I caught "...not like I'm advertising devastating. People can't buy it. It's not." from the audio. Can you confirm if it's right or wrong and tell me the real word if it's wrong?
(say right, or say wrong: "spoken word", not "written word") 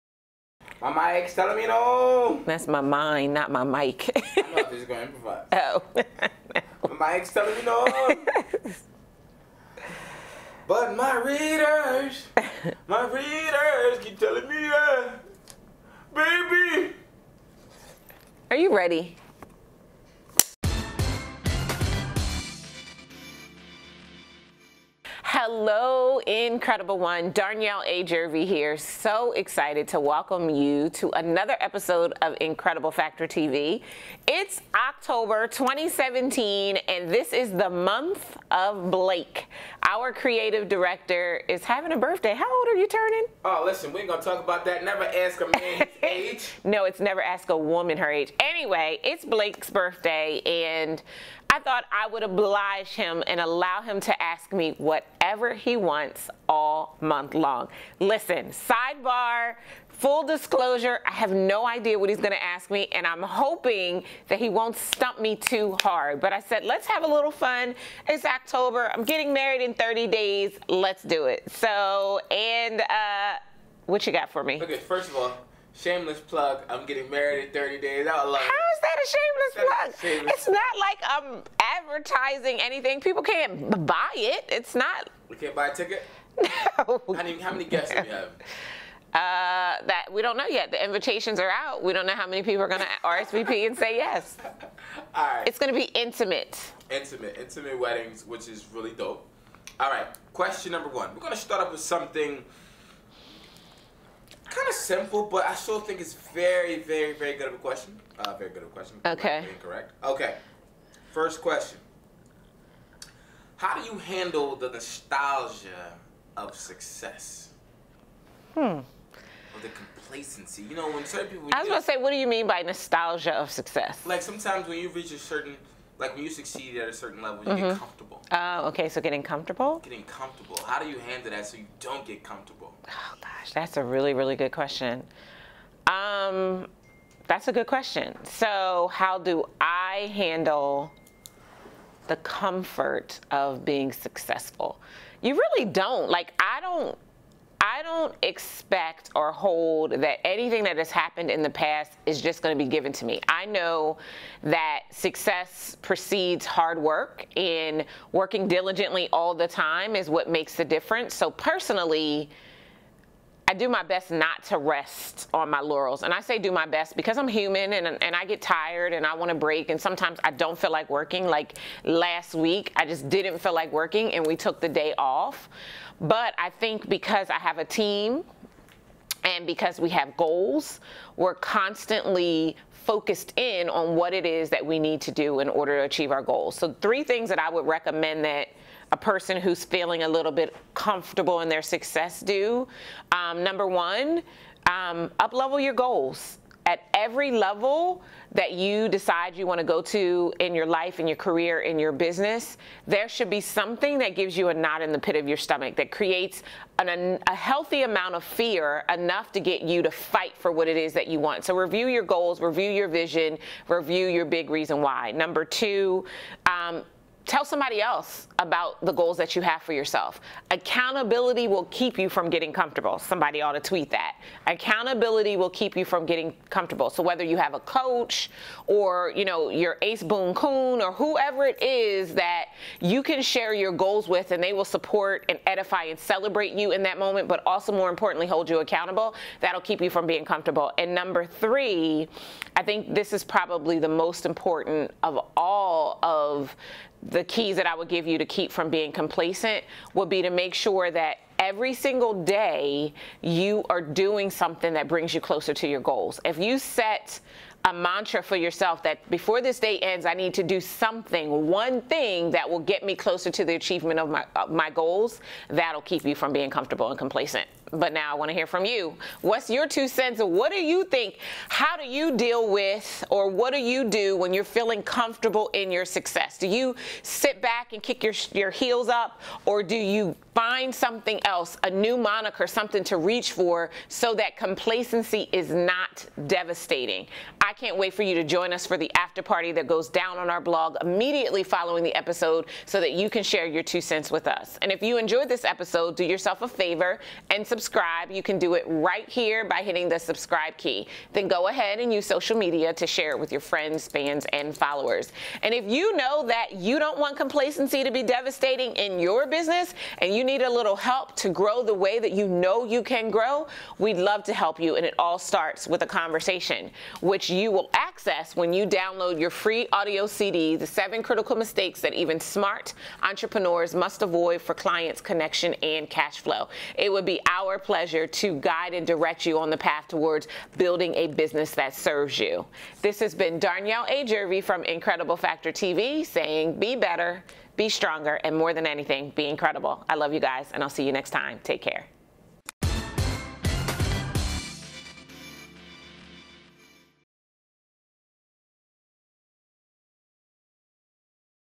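wrong: "anything", not "devastating".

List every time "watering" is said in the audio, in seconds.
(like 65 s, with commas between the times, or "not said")
not said.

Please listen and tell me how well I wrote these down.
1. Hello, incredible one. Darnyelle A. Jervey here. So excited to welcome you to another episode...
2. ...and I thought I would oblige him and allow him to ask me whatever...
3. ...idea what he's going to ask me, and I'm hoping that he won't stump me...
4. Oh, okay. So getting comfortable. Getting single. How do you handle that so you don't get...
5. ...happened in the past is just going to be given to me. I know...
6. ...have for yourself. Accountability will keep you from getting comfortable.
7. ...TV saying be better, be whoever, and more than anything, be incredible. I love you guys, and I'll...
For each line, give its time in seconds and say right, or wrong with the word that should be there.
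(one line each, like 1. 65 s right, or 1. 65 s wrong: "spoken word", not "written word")
1. 25 s right
2. 50 s right
3. 61 s right
4. 128 s wrong: "comfortable", not "single"
5. 150 s right
6. 219 s right
7. 335 s wrong: "stronger", not "whoever".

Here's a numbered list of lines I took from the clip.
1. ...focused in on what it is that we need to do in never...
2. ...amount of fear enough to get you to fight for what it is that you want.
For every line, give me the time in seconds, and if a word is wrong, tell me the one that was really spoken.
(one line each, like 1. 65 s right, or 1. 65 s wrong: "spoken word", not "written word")
1. 182 s wrong: "order", not "never"
2. 207 s right.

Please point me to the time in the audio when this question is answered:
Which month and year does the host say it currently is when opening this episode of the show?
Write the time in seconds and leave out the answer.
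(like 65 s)
34 s.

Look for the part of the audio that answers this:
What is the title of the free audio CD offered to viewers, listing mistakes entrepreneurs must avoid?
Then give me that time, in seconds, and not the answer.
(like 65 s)
320 s.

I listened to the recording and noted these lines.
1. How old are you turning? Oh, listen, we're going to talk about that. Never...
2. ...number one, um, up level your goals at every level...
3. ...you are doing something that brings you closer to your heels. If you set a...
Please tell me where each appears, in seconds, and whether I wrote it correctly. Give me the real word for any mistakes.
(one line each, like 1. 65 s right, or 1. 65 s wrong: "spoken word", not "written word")
1. 42 s right
2. 193 s right
3. 253 s wrong: "goals", not "heels".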